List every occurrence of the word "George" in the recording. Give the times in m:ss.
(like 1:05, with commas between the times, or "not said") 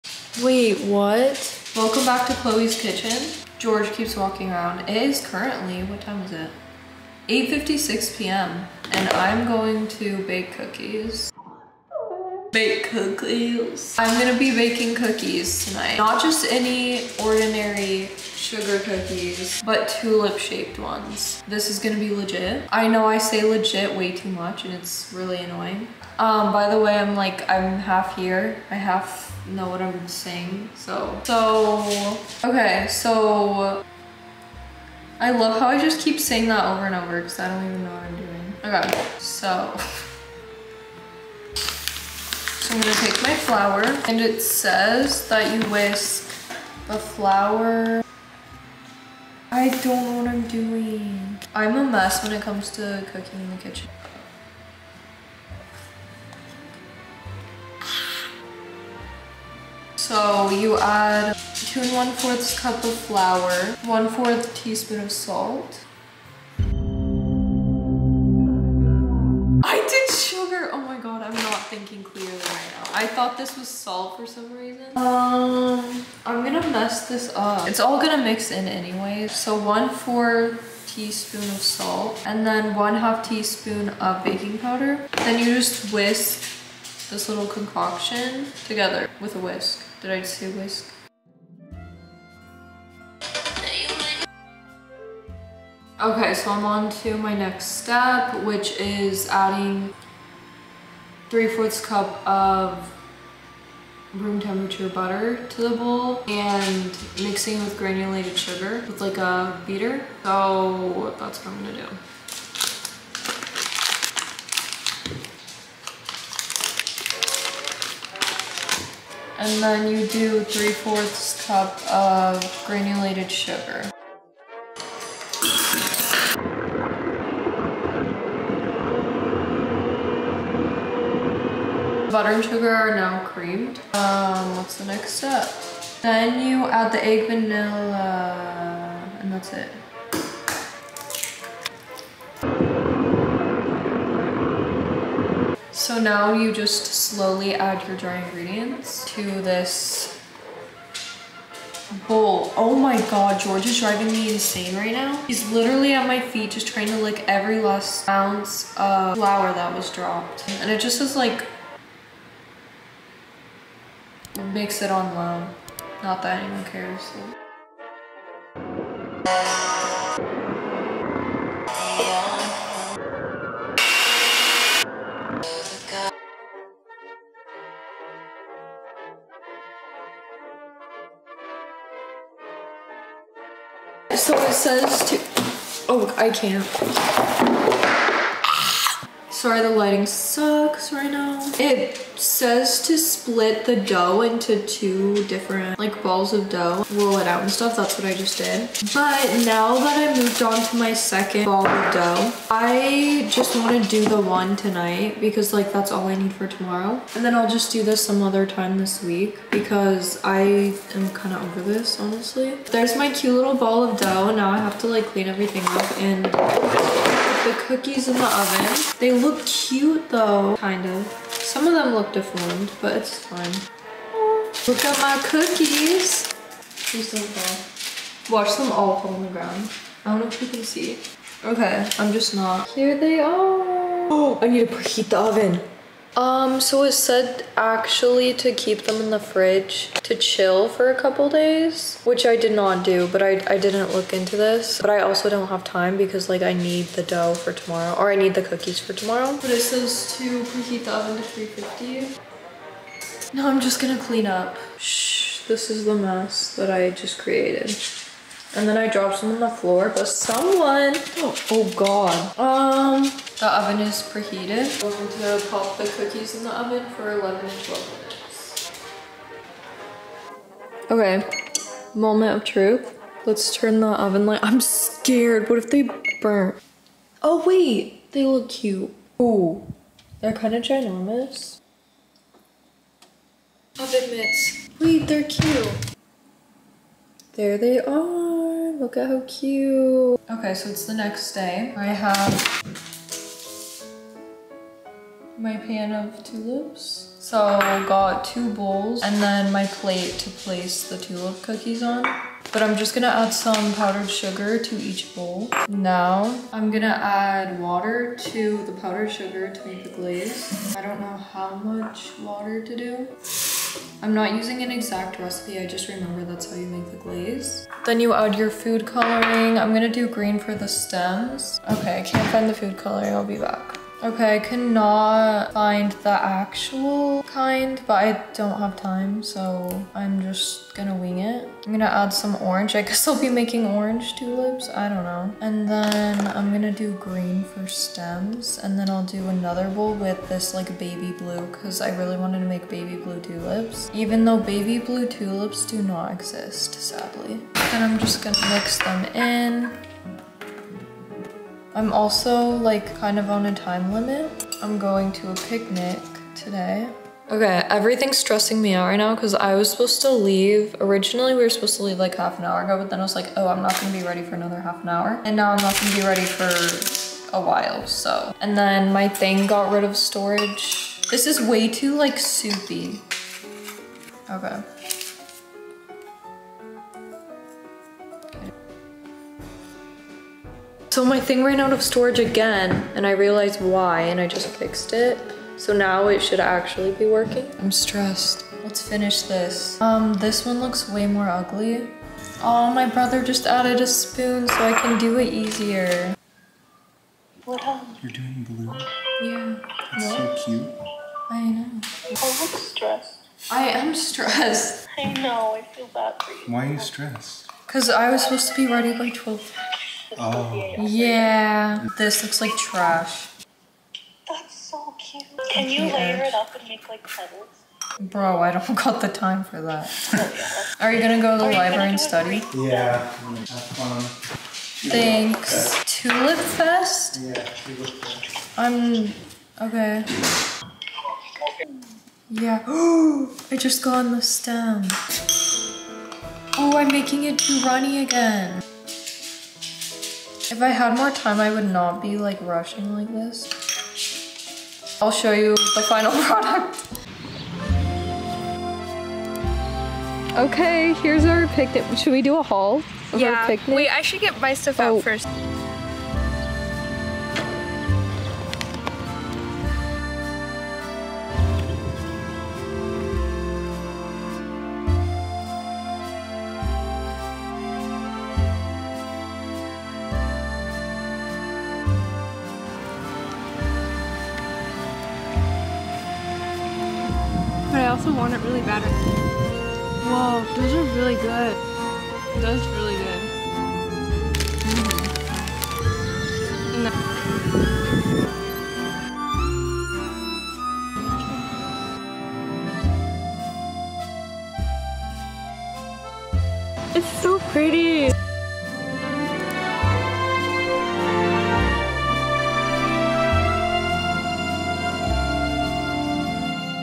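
0:03, 2:33.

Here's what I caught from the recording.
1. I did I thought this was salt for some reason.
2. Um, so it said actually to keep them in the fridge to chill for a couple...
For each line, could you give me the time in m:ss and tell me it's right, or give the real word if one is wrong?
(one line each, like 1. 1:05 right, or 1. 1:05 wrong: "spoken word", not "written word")
1. 1:06 right
2. 3:56 right.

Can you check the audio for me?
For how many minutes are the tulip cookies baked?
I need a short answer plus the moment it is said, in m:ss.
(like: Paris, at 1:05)
11 to 12, at 4:27.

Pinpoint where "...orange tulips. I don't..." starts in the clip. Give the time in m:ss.
5:33.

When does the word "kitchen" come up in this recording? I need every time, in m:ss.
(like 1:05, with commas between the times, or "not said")
0:02, 0:53.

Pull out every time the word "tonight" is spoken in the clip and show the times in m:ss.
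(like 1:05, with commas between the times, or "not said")
0:15, 3:24.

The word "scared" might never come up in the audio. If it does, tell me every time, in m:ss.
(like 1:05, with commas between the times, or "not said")
4:34.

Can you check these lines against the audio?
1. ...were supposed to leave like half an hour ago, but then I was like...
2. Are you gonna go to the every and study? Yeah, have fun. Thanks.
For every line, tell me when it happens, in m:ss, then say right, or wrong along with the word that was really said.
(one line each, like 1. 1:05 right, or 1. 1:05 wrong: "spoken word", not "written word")
1. 6:01 right
2. 7:00 wrong: "library", not "every".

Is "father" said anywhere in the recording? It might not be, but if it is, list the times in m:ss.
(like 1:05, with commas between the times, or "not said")
not said.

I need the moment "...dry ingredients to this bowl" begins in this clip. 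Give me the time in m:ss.
2:27.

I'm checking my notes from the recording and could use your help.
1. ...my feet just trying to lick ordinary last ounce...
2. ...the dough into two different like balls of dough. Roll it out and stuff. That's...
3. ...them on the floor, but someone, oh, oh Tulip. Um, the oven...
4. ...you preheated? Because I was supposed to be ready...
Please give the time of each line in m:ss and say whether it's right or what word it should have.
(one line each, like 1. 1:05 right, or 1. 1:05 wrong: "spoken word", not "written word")
1. 2:36 wrong: "every", not "ordinary"
2. 3:13 right
3. 4:19 wrong: "God", not "Tulip"
4. 6:46 wrong: "stressed", not "preheated".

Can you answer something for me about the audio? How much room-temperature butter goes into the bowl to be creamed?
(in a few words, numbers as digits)
3/4 cup.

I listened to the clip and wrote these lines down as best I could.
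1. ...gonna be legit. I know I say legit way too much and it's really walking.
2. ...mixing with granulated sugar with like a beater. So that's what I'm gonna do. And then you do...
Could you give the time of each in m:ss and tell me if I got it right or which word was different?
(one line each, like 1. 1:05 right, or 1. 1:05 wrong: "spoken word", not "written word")
1. 0:21 wrong: "annoying", not "walking"
2. 1:47 right.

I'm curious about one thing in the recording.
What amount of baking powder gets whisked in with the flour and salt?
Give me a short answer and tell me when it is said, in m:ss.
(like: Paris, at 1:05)
1/2 teaspoon, at 1:22.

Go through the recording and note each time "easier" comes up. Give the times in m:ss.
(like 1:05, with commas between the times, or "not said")
6:35.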